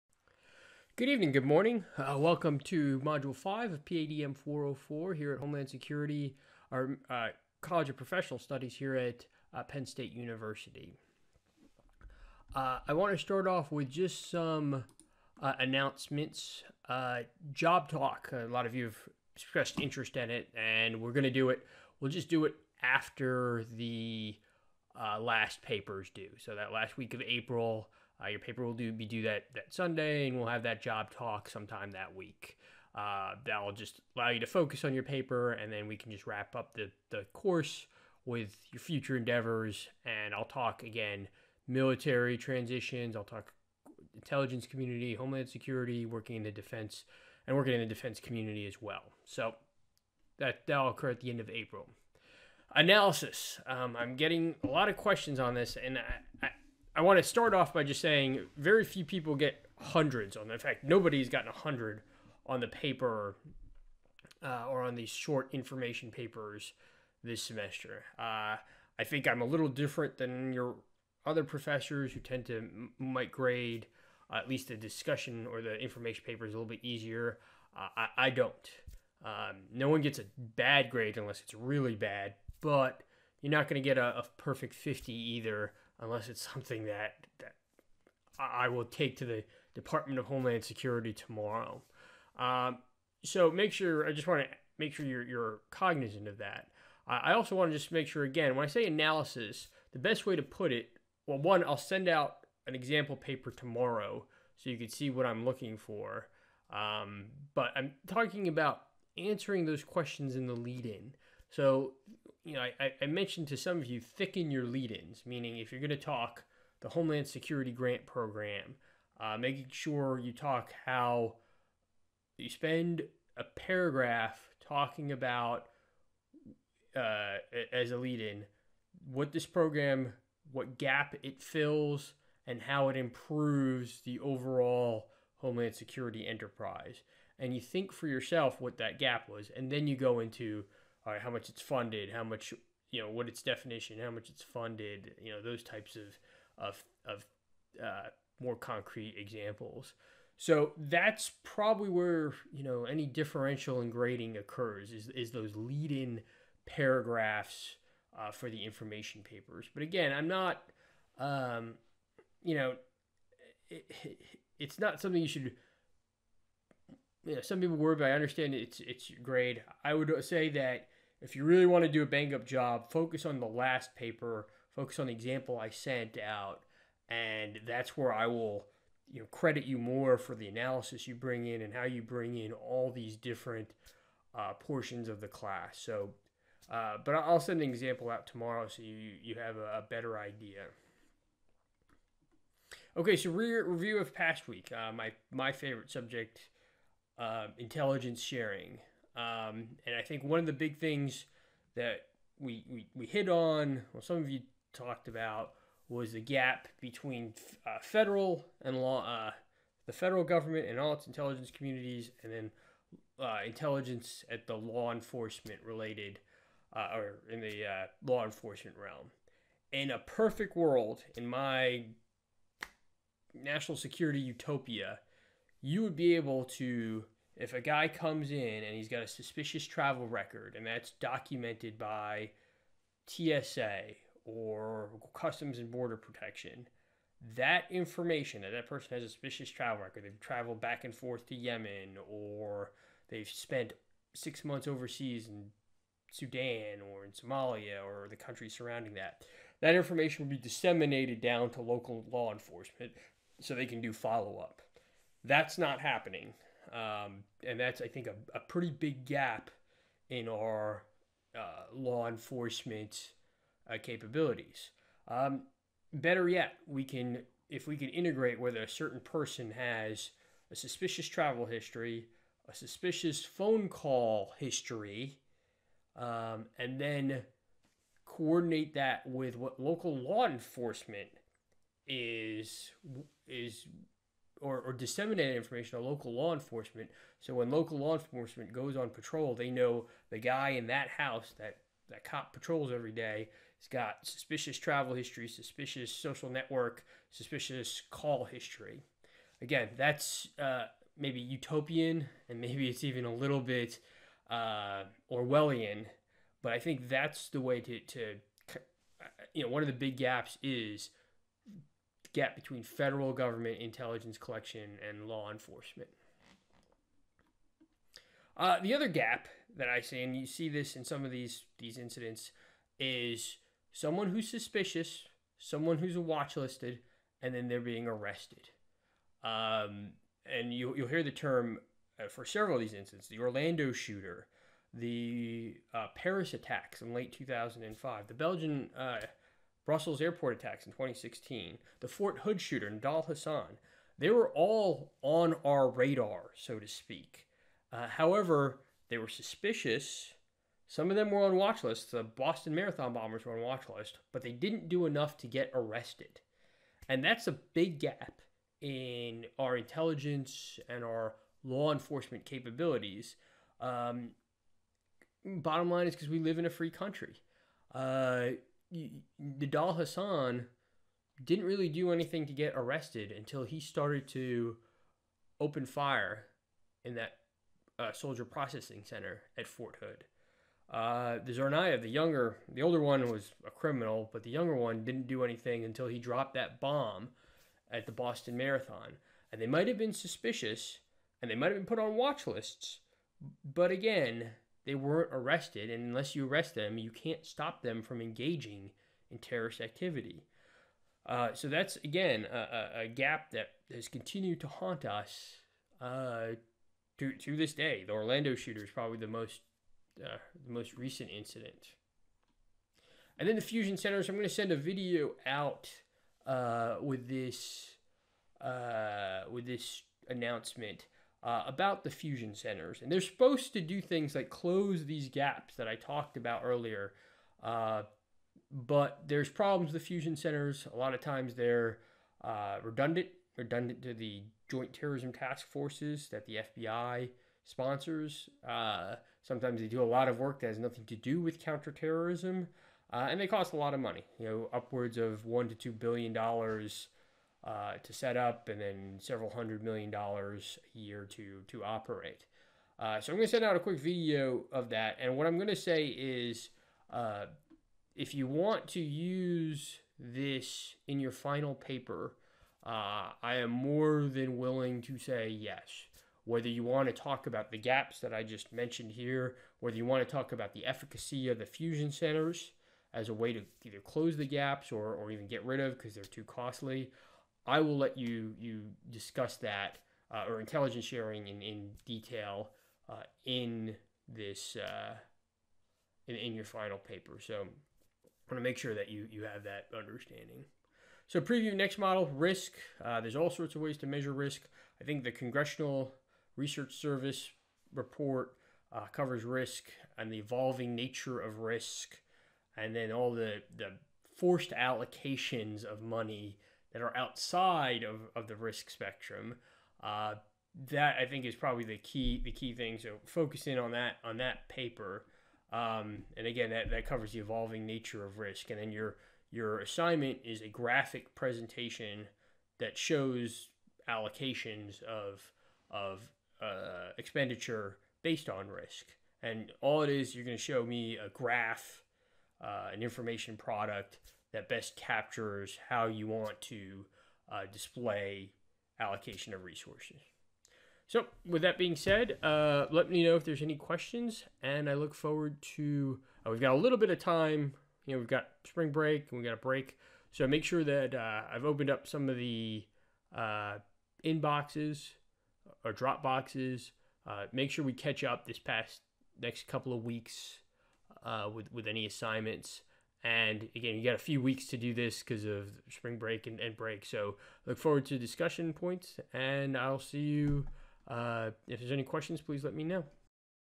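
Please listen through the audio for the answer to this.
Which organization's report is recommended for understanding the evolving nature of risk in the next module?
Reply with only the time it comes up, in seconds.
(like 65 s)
495 s.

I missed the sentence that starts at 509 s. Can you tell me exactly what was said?
Uh, that I think is probably the key the key thing.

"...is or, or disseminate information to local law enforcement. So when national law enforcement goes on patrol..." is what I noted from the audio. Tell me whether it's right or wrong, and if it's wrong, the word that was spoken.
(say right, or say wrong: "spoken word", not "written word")
wrong: "local", not "national".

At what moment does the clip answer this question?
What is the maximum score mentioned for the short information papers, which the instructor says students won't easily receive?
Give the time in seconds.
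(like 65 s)
84 s.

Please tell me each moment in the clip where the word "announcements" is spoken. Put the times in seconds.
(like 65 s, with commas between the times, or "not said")
15 s, 420 s.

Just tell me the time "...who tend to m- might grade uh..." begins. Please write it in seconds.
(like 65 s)
72 s.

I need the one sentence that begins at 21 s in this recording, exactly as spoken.
We'll just do it after the last papers due.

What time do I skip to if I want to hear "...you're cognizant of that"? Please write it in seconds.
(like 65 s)
95 s.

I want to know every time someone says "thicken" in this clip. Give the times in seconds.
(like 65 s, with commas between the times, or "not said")
113 s.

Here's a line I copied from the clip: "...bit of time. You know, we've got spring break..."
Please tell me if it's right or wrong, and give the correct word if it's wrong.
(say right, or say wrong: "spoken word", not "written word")
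right.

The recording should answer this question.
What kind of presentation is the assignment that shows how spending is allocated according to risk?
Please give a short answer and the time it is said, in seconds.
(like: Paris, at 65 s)
graphic presentation, at 520 s.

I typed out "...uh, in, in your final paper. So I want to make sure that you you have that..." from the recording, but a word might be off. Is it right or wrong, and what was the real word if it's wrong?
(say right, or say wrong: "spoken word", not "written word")
right.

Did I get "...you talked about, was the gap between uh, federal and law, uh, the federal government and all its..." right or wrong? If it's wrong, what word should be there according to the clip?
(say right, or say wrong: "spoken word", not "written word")
right.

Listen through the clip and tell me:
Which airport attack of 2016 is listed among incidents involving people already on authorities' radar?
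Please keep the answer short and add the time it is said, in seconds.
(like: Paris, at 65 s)
Brussels airport attacks, at 339 s.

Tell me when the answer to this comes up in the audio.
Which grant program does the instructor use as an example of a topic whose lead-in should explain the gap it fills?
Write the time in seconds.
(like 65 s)
116 s.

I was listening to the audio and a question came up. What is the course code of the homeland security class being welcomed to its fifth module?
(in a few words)
PADM 404.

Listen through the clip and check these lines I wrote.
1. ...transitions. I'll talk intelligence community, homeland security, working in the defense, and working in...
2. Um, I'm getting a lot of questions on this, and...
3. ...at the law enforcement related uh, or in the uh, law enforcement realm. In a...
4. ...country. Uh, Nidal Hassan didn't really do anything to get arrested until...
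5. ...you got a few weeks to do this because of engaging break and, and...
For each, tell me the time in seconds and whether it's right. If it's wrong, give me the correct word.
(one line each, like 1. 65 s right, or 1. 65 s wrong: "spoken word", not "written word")
1. 42 s right
2. 53 s right
3. 214 s right
4. 366 s right
5. 563 s wrong: "spring", not "engaging".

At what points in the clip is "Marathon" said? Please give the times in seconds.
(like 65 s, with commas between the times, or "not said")
352 s, 388 s.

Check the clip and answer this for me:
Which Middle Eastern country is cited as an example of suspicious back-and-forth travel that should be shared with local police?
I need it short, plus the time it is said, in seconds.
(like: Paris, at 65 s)
Yemen, at 241 s.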